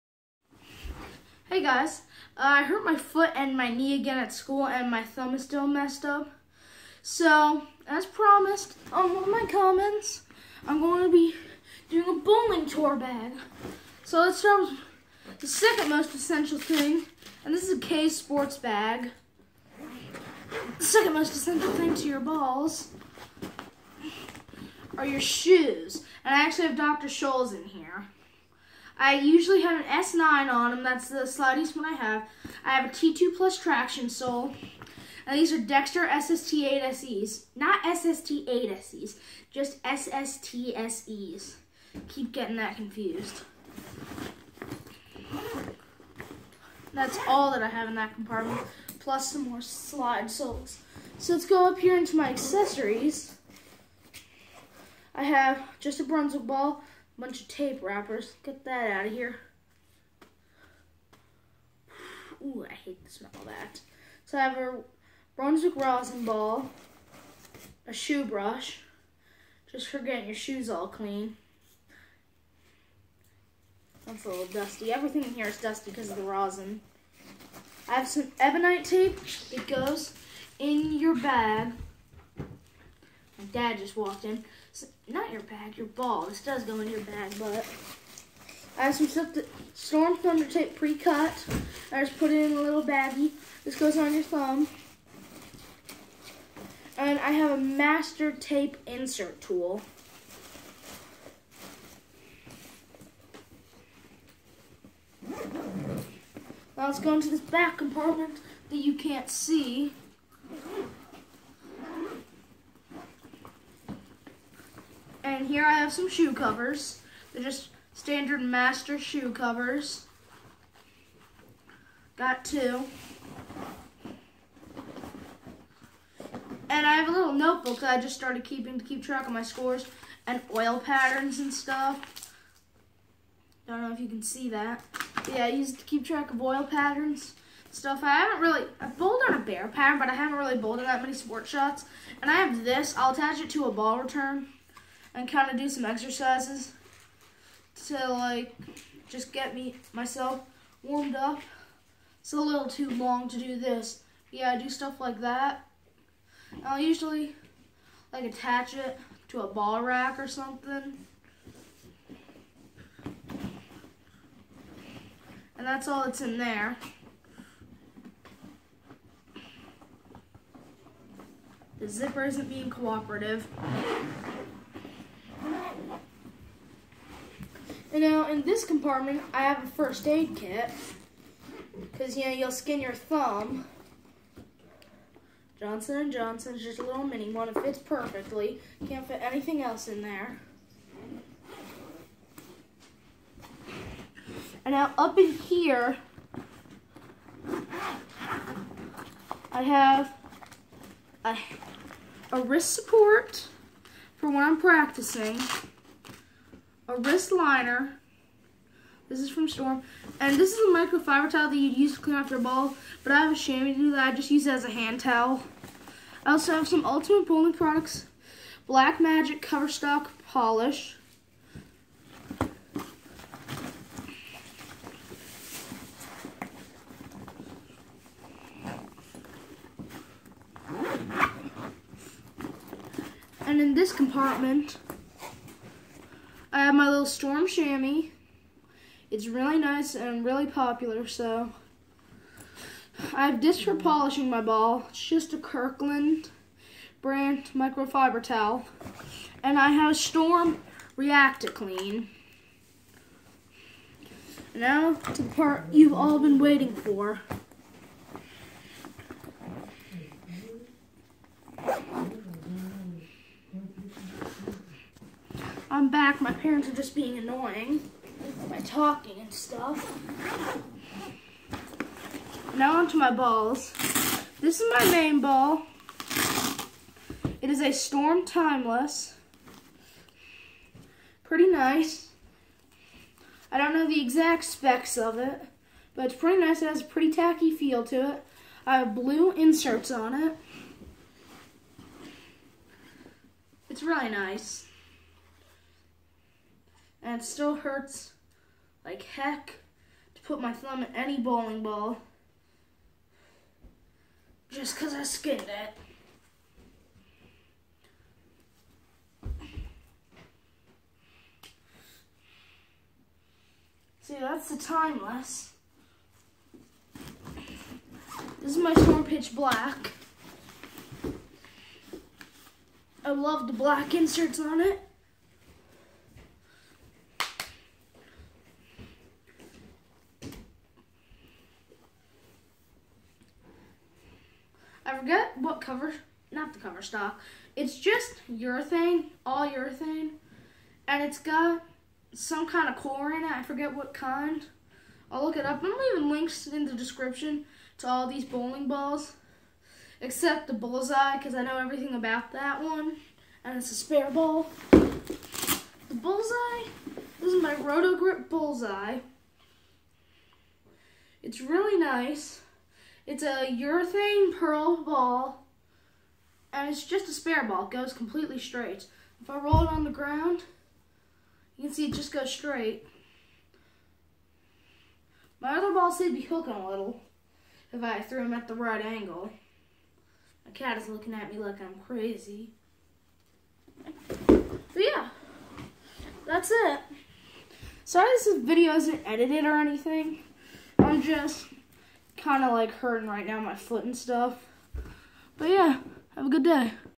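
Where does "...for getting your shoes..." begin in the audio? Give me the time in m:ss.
1:09.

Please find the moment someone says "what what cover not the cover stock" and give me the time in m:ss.
5:35.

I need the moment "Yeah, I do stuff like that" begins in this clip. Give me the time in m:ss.
2:34.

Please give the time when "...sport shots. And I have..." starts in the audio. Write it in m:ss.
2:21.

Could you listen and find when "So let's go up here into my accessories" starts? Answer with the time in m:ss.
0:51.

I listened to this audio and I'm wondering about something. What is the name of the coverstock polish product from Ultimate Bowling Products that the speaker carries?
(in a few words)
Black Magic.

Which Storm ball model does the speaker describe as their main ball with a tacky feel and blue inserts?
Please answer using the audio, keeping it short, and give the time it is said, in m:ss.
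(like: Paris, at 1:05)
Storm Timeless, at 4:37.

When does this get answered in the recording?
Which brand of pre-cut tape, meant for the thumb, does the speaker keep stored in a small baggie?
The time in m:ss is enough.
1:29.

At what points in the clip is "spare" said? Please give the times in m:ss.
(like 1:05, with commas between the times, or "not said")
5:53, 6:07.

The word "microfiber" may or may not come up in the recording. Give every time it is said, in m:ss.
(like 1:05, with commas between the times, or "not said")
3:30, 4:07.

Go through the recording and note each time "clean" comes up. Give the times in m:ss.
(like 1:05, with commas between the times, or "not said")
1:10, 3:32, 4:11.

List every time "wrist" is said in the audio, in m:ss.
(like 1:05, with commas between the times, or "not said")
3:22, 3:27.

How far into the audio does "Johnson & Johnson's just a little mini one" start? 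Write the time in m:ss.
3:05.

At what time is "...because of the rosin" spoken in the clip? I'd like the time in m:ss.
1:15.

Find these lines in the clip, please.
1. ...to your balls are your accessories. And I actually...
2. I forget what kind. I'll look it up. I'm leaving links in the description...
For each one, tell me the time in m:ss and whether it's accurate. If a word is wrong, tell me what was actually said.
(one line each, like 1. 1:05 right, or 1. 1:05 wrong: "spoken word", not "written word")
1. 0:21 wrong: "shoes", not "accessories"
2. 5:43 right.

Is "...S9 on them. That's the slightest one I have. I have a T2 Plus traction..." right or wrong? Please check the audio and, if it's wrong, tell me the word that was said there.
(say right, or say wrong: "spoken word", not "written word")
right.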